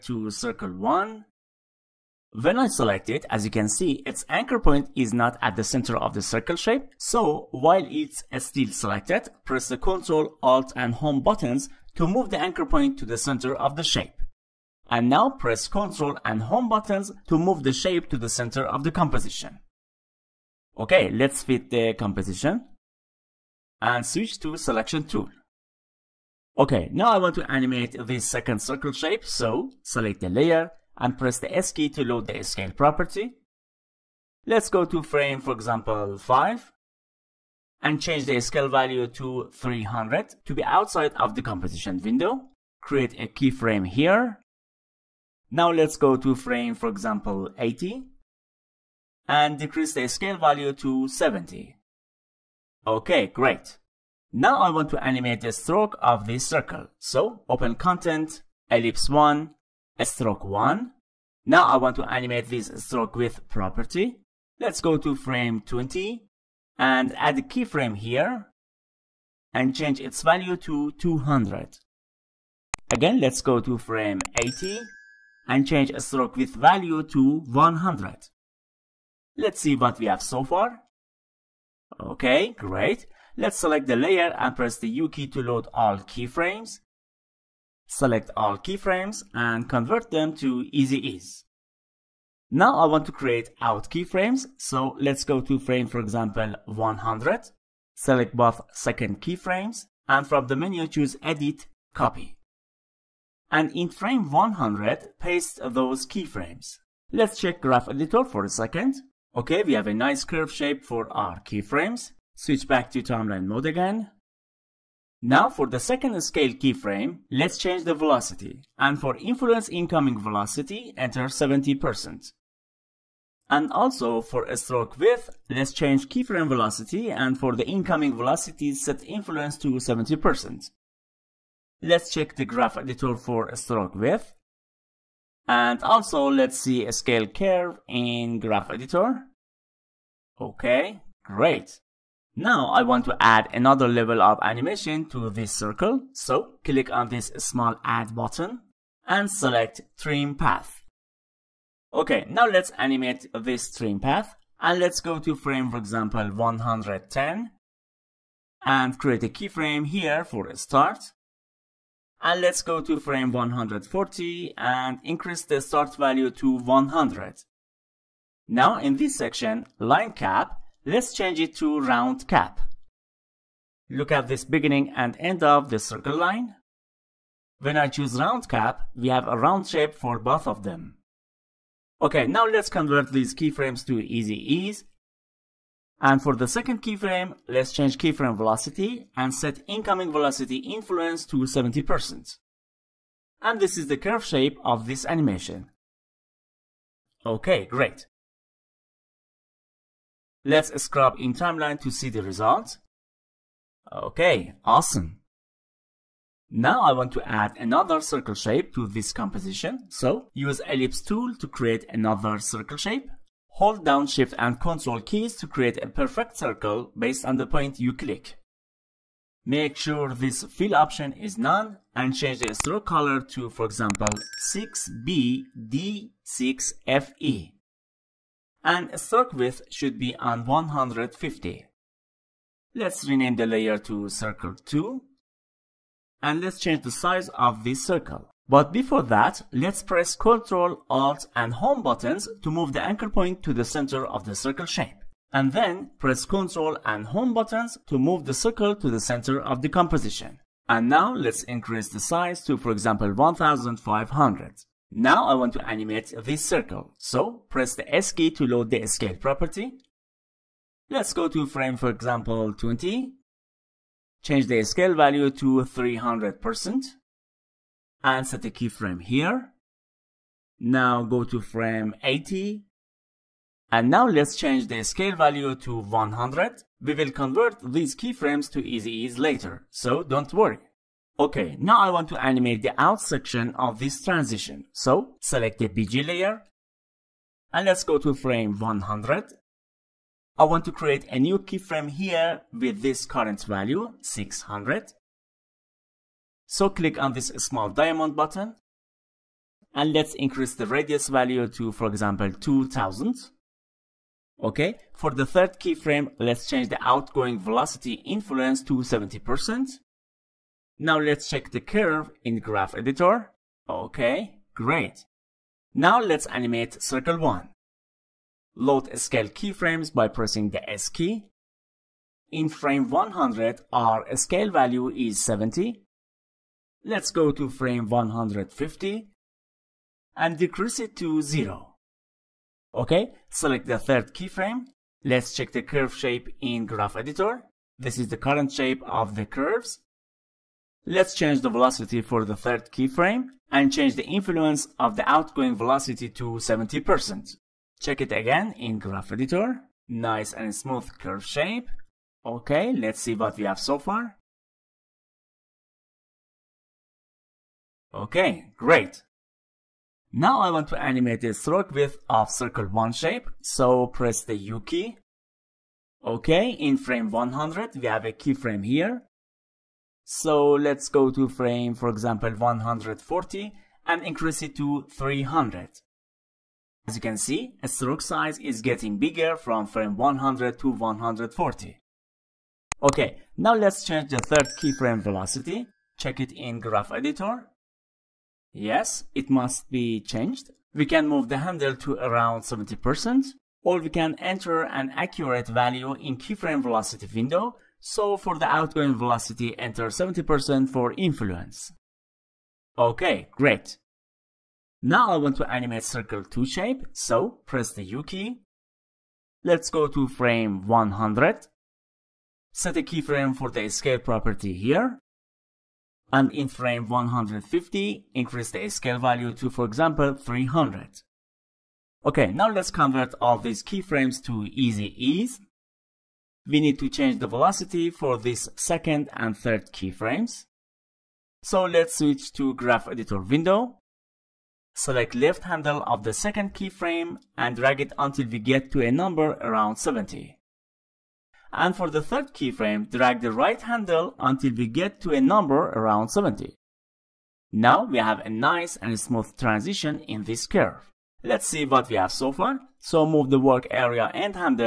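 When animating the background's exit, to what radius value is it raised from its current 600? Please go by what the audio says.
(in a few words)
2000.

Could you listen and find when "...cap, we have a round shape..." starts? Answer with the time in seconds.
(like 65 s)
178 s.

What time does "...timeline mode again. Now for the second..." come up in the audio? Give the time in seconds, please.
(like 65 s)
113 s.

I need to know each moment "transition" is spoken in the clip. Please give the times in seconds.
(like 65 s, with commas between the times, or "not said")
284 s, 449 s.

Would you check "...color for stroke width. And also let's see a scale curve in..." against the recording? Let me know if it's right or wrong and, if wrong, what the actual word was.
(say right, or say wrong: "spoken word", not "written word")
wrong: "editor", not "color".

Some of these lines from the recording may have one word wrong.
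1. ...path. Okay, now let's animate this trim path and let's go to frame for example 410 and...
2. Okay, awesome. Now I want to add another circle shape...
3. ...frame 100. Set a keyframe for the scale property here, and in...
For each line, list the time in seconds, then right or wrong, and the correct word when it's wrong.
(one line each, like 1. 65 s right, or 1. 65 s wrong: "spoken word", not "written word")
1. 150 s wrong: "110", not "410"
2. 203 s right
3. 410 s right.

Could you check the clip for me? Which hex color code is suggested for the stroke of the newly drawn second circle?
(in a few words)
6BD6FE.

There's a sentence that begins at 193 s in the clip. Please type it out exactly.
And this is the curve shape of this animation.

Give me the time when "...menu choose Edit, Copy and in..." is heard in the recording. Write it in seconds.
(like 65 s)
100 s.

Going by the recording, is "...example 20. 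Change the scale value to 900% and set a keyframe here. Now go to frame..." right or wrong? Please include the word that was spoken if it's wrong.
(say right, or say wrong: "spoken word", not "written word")
wrong: "300", not "900".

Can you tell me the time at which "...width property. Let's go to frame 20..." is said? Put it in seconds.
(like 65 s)
63 s.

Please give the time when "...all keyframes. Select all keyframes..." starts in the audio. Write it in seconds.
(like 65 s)
85 s.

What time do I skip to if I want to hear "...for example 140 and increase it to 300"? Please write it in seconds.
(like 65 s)
371 s.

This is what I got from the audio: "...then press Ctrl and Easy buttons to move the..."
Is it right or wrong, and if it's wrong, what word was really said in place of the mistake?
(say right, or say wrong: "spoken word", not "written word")
wrong: "Home", not "Easy".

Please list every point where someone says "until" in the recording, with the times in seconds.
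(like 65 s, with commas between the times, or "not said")
437 s, 444 s.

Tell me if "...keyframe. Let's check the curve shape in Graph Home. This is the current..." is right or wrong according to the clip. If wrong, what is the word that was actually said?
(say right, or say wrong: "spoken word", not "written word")
wrong: "Editor", not "Home".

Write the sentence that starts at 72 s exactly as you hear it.
Again, let's go to frame 80 and change a stroke width value to 100.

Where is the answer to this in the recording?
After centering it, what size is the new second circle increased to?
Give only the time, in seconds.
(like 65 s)
253 s.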